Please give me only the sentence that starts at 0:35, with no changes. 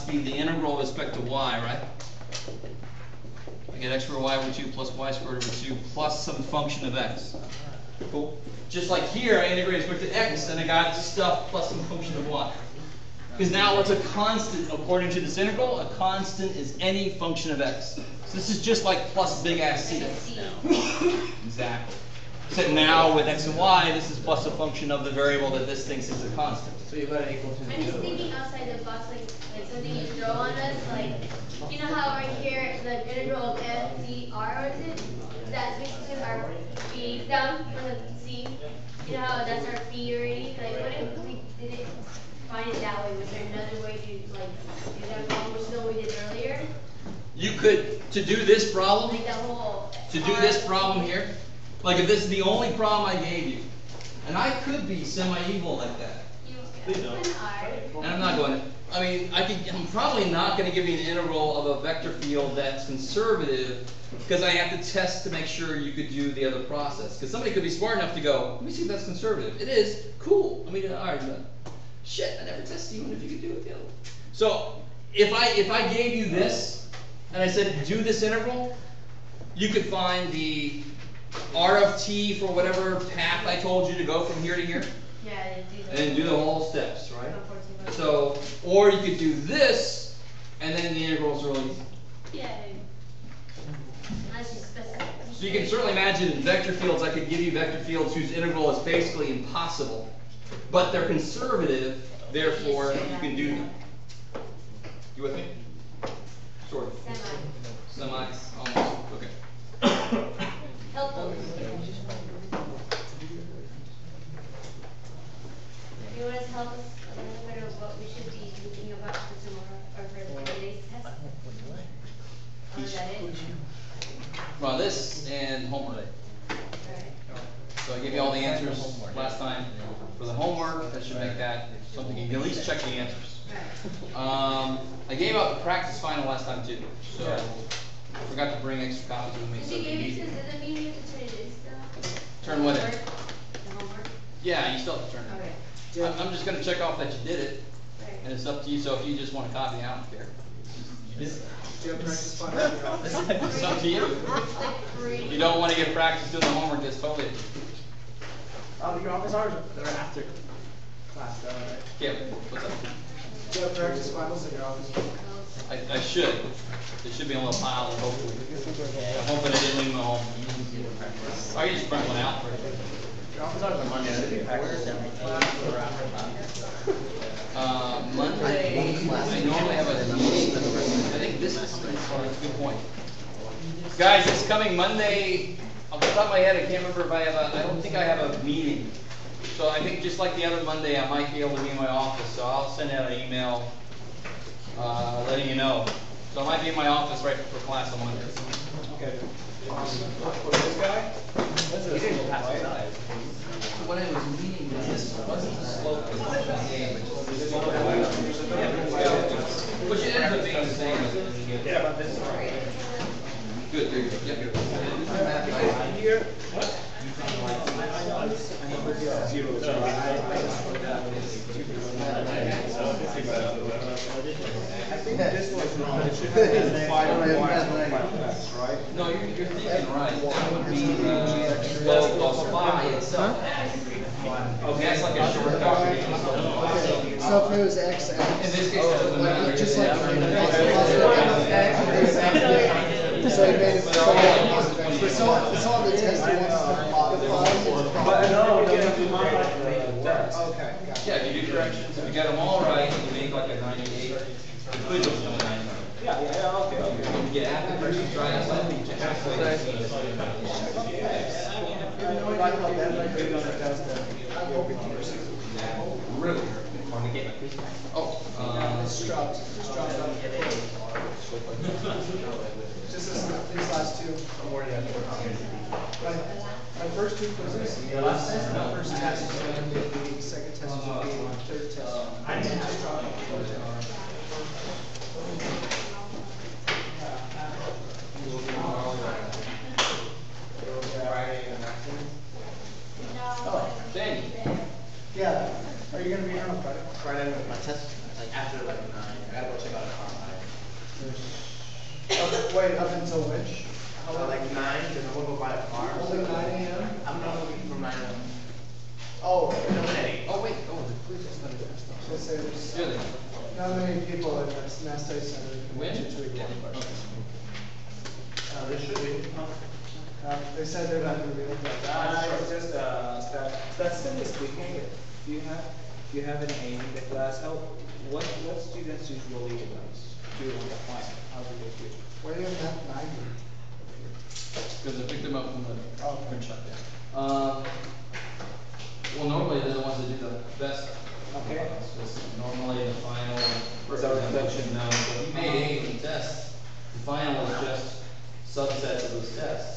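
That's basically our b down from the z?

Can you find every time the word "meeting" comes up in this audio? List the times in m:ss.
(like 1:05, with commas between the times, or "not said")
3:00, 3:08.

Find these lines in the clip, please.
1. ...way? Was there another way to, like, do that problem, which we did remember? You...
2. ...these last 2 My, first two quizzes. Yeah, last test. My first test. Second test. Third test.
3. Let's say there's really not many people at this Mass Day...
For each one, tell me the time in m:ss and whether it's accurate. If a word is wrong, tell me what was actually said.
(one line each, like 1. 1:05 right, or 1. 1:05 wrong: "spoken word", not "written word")
1. 0:43 wrong: "earlier", not "remember"
2. 4:33 right
3. 5:12 right.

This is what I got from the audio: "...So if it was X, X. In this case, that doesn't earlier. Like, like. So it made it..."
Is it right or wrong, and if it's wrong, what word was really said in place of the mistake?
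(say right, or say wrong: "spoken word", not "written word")
wrong: "matter", not "earlier".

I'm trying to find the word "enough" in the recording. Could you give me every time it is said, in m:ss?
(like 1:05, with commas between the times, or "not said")
1:07.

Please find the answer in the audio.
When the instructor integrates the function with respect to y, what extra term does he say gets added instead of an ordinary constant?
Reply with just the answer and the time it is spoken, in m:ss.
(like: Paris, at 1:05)
some function of x, at 0:06.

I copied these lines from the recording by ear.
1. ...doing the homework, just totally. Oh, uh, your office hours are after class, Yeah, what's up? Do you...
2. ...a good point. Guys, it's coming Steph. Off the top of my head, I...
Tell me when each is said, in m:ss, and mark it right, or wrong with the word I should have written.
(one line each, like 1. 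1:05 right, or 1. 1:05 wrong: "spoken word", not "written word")
1. 2:36 right
2. 3:01 wrong: "Monday", not "Steph".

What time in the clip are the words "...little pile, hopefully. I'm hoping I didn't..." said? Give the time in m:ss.
2:47.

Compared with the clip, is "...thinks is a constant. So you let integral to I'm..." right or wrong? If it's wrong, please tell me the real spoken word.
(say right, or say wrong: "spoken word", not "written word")
wrong: "equal", not "integral".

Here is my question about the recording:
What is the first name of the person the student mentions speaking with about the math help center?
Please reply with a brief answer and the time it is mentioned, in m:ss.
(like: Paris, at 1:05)
Stephanie, at 5:23.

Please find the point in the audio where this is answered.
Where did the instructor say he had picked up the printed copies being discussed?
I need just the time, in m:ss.
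5:36.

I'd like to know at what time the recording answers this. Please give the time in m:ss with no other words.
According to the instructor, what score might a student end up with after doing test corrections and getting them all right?
4:13.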